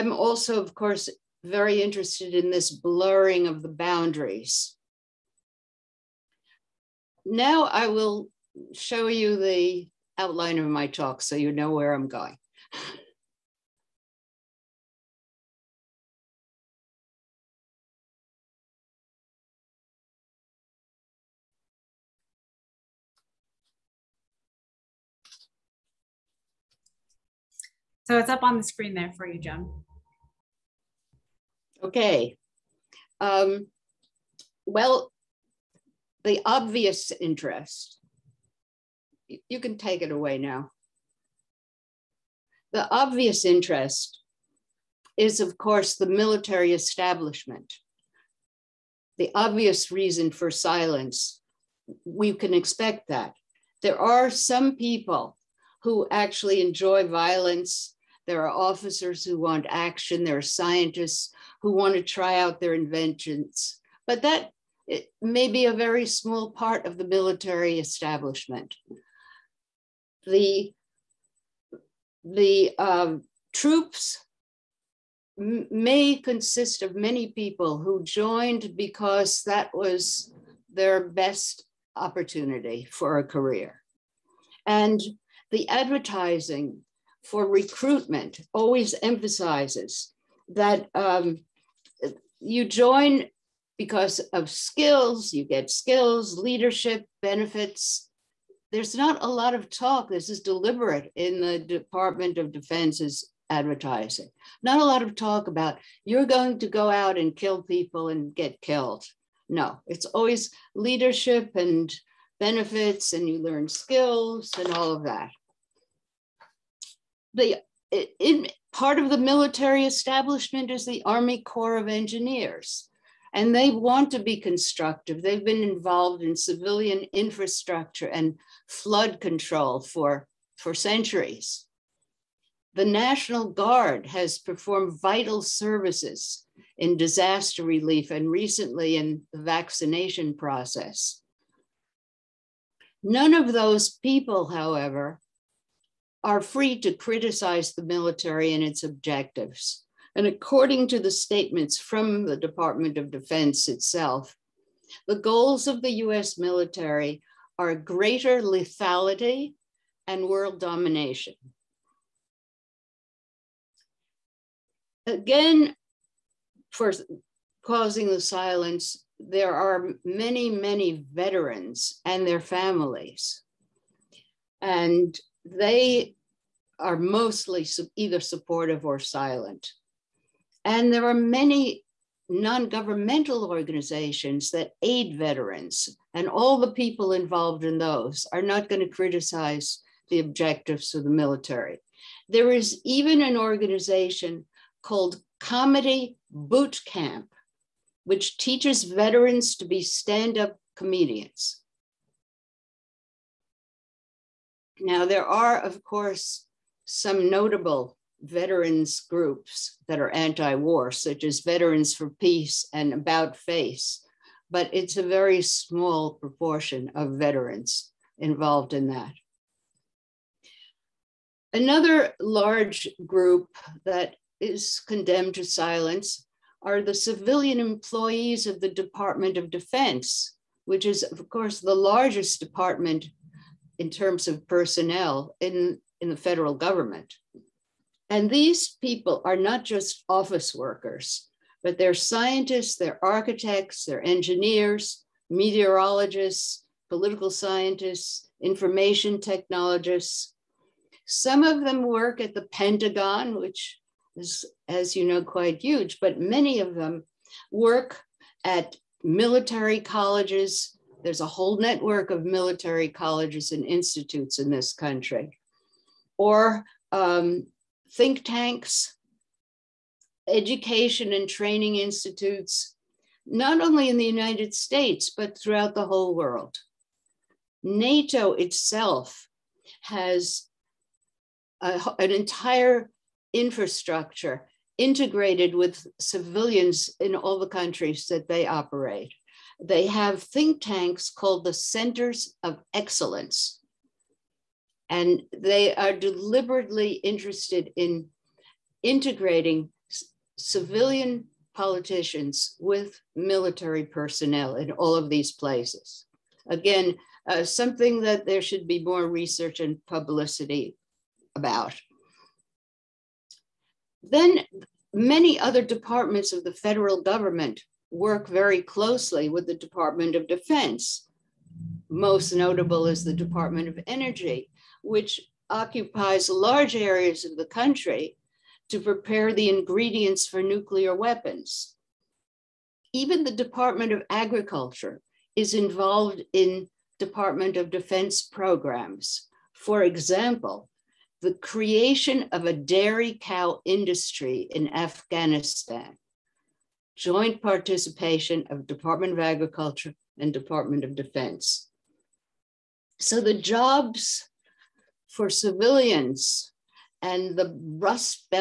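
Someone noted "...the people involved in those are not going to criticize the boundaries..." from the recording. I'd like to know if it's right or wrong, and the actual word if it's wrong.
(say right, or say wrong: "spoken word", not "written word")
wrong: "objectives", not "boundaries".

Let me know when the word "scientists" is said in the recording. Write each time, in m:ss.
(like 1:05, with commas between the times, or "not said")
1:00, 4:01, 4:07.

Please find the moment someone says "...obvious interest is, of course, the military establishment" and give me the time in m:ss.
0:42.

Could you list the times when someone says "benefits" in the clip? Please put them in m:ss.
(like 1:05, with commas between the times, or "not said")
1:37, 1:52.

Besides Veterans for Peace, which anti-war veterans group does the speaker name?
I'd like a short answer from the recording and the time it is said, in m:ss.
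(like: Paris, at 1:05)
About Face, at 3:32.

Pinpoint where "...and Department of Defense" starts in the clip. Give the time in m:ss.
5:50.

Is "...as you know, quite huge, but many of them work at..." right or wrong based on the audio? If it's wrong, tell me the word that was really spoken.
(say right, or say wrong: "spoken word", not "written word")
right.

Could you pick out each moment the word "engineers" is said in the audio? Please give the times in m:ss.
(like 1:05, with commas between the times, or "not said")
2:01, 4:04.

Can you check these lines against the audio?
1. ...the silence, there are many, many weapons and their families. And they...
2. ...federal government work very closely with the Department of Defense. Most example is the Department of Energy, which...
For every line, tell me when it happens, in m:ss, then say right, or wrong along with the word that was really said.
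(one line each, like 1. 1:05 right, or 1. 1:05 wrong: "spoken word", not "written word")
1. 2:48 wrong: "veterans", not "weapons"
2. 5:16 wrong: "notable", not "example".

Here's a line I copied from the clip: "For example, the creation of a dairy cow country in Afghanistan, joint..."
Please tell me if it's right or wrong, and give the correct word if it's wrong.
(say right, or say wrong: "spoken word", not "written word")
wrong: "industry", not "country".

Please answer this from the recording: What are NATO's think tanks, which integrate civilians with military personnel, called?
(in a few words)
Centers of Excellence.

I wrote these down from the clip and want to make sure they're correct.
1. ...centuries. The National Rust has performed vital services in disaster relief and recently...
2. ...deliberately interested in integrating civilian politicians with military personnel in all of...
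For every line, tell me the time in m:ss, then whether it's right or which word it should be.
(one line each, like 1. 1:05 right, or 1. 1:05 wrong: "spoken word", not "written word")
1. 2:10 wrong: "Guard", not "Rust"
2. 4:55 right.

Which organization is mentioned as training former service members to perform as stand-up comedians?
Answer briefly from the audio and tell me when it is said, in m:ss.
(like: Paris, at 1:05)
Comedy Boot Camp, at 3:15.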